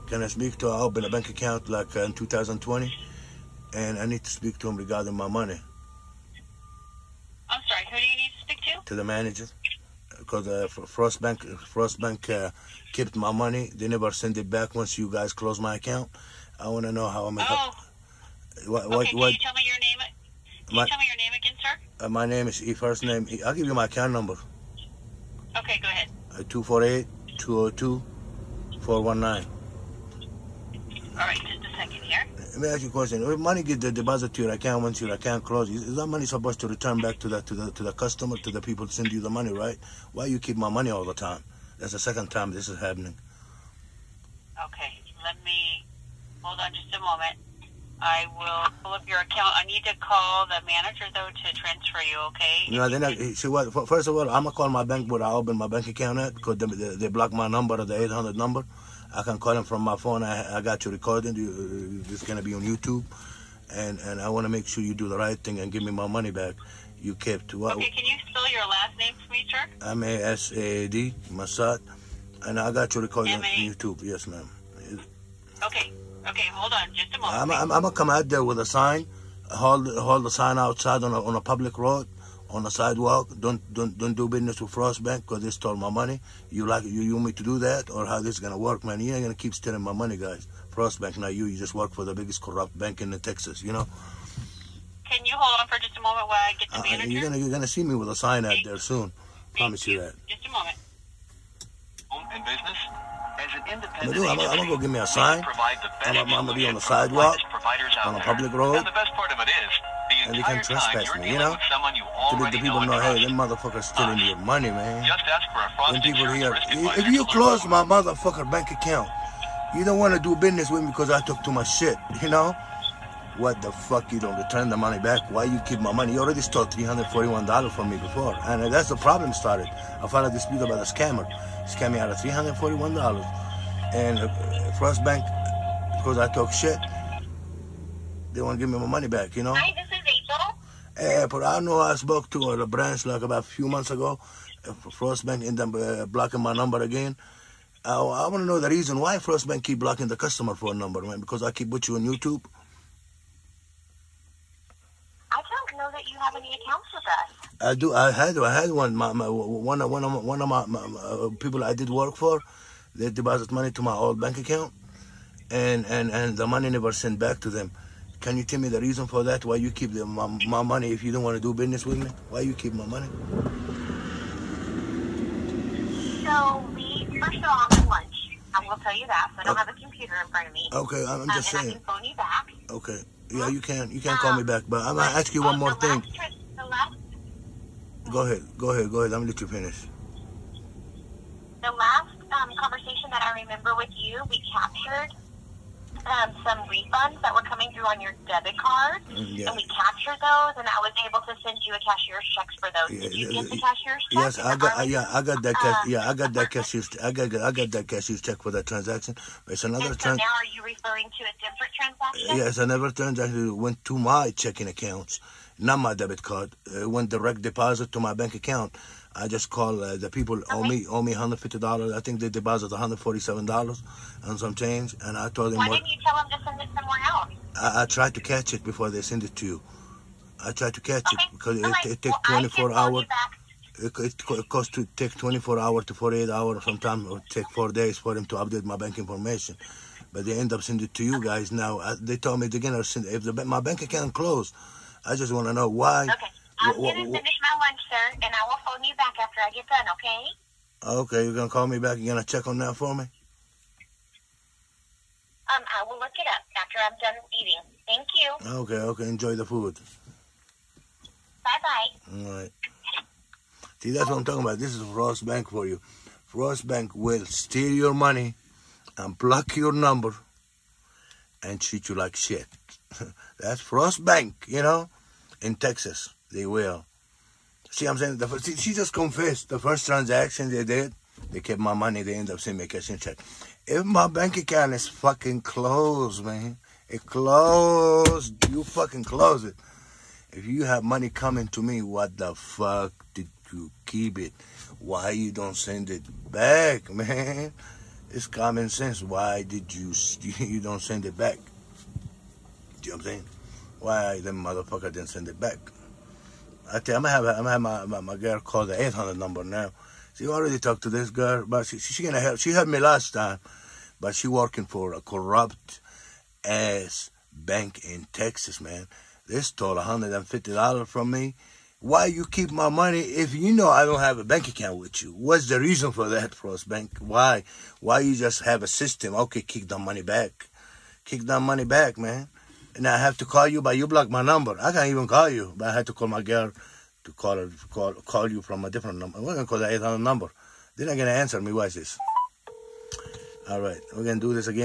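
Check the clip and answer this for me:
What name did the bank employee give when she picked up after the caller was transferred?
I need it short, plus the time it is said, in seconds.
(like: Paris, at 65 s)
April, at 140 s.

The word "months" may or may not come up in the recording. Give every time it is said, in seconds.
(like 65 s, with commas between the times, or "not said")
143 s.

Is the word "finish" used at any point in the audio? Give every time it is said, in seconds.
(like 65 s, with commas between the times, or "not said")
189 s, 247 s.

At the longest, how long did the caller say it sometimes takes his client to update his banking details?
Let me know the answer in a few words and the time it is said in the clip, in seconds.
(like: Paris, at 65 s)
4 days, at 237 s.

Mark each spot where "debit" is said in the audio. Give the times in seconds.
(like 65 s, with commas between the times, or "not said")
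198 s, 215 s.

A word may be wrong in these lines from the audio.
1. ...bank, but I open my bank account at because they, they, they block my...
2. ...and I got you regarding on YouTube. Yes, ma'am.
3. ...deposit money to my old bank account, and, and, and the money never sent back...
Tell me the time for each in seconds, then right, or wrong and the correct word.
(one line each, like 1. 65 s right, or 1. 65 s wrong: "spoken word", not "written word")
1. 54 s right
2. 72 s wrong: "recording", not "regarding"
3. 163 s right.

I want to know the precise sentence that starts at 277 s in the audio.
See, I'm saying the first, she just confessed the first transaction they did.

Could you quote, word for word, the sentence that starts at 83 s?
Don't don't don't do business with Frost Bank because they stole my money.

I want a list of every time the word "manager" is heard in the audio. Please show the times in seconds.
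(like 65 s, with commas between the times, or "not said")
9 s, 50 s, 96 s.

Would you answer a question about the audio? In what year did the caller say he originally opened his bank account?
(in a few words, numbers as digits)
2020.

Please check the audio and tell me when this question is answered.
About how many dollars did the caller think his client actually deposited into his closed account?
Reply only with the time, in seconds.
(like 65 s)
222 s.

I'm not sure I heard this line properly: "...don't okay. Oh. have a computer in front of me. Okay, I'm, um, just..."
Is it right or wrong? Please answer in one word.
right.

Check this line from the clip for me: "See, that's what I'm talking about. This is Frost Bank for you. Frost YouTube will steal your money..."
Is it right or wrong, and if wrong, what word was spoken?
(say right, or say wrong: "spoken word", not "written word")
wrong: "Bank", not "YouTube".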